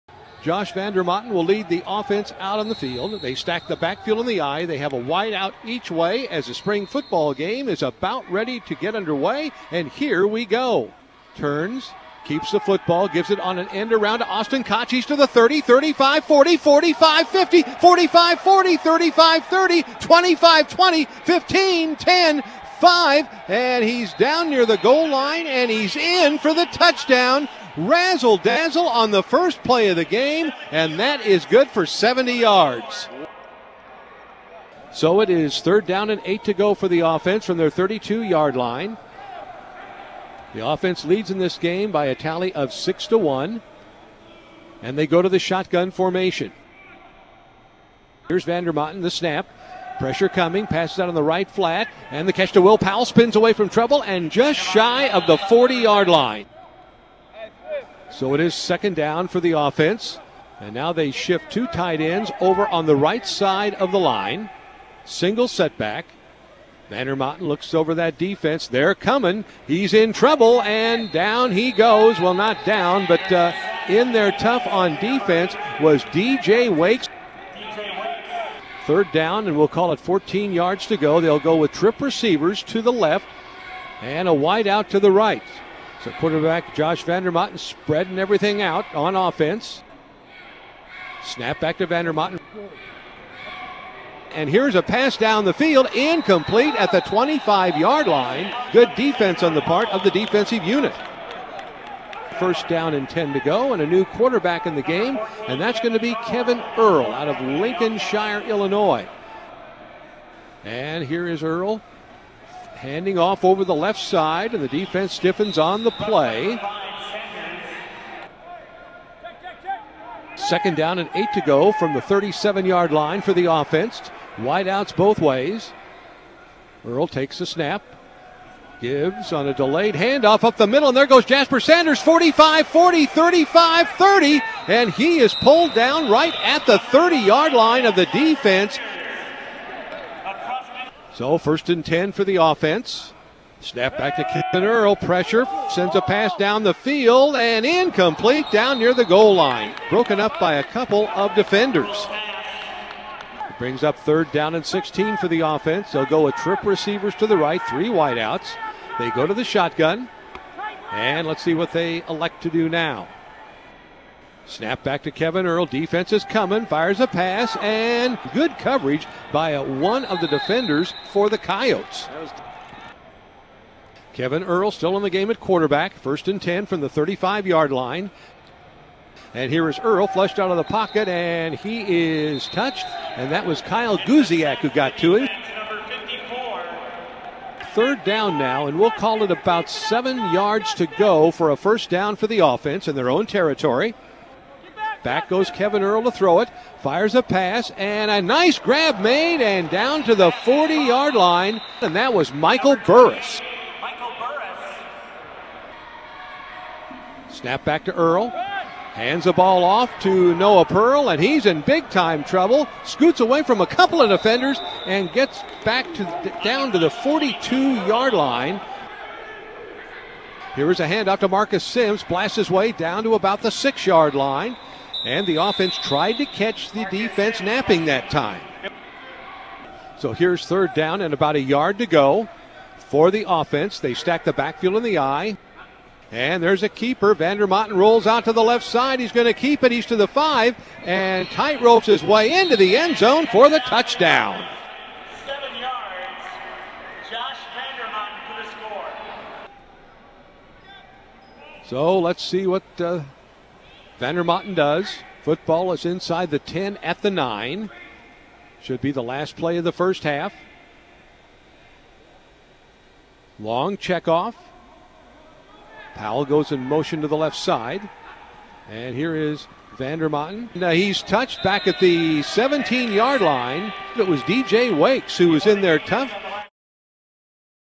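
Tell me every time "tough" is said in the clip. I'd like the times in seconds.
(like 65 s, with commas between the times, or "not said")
74 s, 275 s.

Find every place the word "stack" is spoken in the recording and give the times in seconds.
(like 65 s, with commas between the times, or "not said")
3 s, 233 s.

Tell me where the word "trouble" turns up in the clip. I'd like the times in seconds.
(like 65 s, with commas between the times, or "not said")
53 s, 70 s, 212 s.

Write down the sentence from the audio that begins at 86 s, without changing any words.
So quarterback Josh Vandermotten spreading everything out on offense.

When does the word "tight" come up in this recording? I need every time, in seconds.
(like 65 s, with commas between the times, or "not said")
61 s, 241 s.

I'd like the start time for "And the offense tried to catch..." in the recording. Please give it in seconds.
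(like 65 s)
225 s.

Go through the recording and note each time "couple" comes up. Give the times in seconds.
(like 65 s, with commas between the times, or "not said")
150 s, 213 s.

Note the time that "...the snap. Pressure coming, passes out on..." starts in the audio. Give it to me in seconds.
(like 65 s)
49 s.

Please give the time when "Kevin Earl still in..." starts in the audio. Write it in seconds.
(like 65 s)
174 s.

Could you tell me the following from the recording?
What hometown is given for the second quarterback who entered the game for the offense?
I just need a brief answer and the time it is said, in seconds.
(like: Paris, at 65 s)
Lincolnshire, Illinois, at 107 s.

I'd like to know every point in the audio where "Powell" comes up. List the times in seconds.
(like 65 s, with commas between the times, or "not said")
52 s, 265 s.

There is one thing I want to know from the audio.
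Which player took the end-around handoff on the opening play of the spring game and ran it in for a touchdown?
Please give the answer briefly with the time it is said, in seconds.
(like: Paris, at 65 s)
Austin Kachis, at 14 s.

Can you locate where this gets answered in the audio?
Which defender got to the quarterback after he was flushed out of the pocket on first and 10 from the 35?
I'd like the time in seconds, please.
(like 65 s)
183 s.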